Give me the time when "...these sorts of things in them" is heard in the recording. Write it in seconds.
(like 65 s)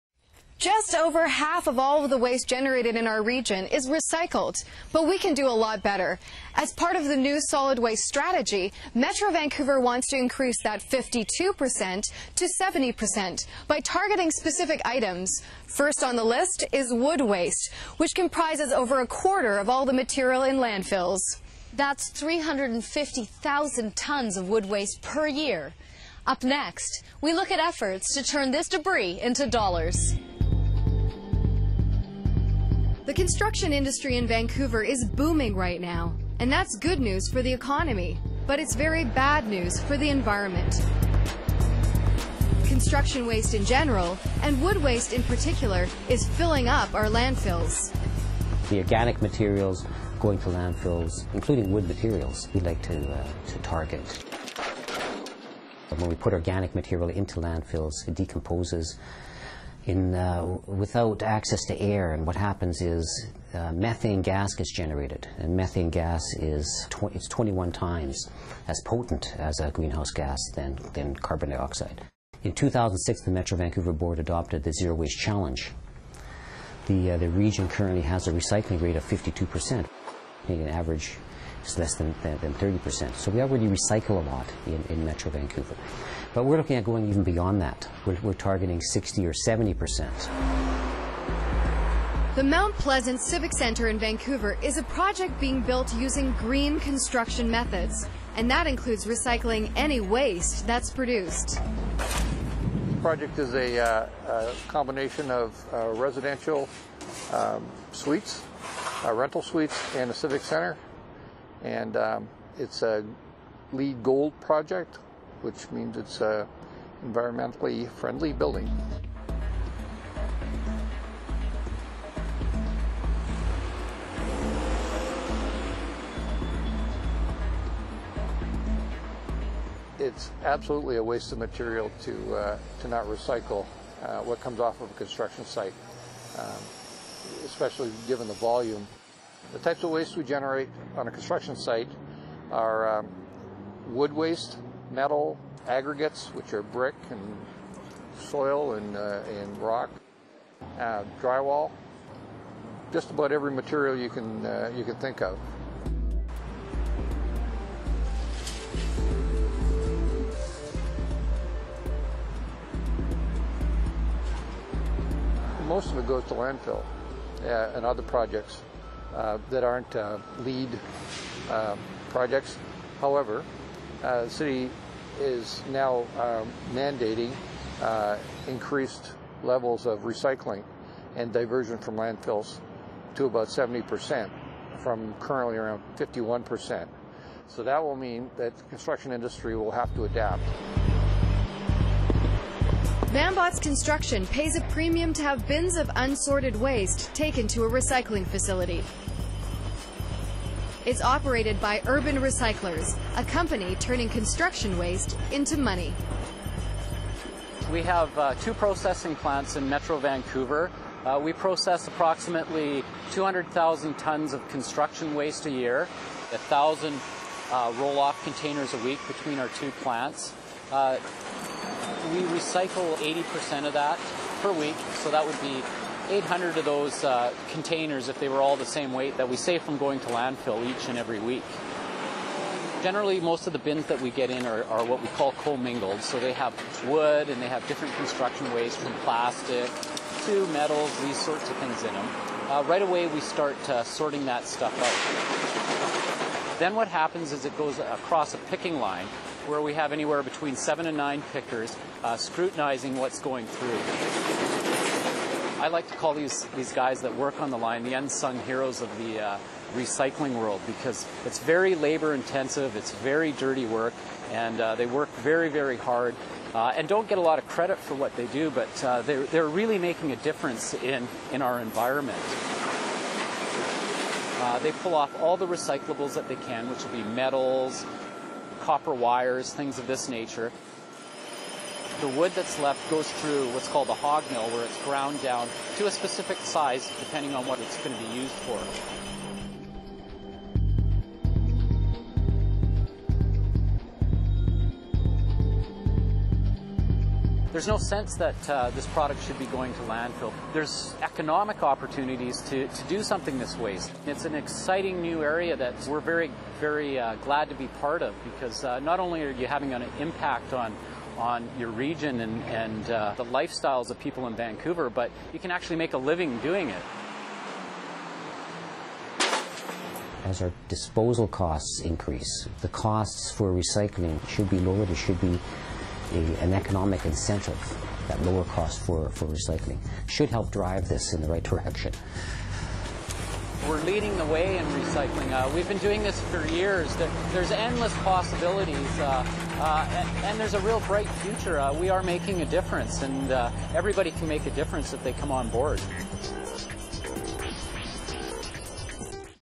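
241 s.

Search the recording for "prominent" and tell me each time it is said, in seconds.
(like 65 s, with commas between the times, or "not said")
not said.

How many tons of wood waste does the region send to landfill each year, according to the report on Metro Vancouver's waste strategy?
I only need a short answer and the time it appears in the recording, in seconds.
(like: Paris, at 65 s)
350,000 tons, at 22 s.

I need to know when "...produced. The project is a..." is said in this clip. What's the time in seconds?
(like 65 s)
100 s.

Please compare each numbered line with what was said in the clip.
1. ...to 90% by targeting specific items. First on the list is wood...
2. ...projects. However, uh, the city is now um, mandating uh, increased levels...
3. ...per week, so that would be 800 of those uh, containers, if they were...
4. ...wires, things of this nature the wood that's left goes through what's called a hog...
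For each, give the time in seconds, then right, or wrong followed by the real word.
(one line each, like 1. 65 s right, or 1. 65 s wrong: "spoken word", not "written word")
1. 12 s wrong: "70", not "90"
2. 172 s right
3. 224 s right
4. 278 s right.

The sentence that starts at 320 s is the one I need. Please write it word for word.
As our disposal costs increase, the costs for recycling should be lowered.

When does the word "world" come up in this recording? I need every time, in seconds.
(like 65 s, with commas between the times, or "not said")
260 s.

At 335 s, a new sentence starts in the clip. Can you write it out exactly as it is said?
Uh, we've been doing this for years.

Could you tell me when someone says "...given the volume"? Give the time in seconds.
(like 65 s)
138 s.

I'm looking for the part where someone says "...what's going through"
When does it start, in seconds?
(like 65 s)
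252 s.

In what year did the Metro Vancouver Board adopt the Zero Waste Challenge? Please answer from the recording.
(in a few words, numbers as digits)
2006.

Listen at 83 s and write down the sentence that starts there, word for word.
So we already recycle a lot in, in Metro Vancouver.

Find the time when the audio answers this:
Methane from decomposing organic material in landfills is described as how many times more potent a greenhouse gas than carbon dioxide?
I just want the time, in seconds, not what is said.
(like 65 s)
67 s.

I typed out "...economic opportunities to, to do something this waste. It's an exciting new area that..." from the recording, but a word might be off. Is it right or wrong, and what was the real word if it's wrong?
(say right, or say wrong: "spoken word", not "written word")
right.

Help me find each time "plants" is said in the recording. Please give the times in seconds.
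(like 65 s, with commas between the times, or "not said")
209 s, 219 s.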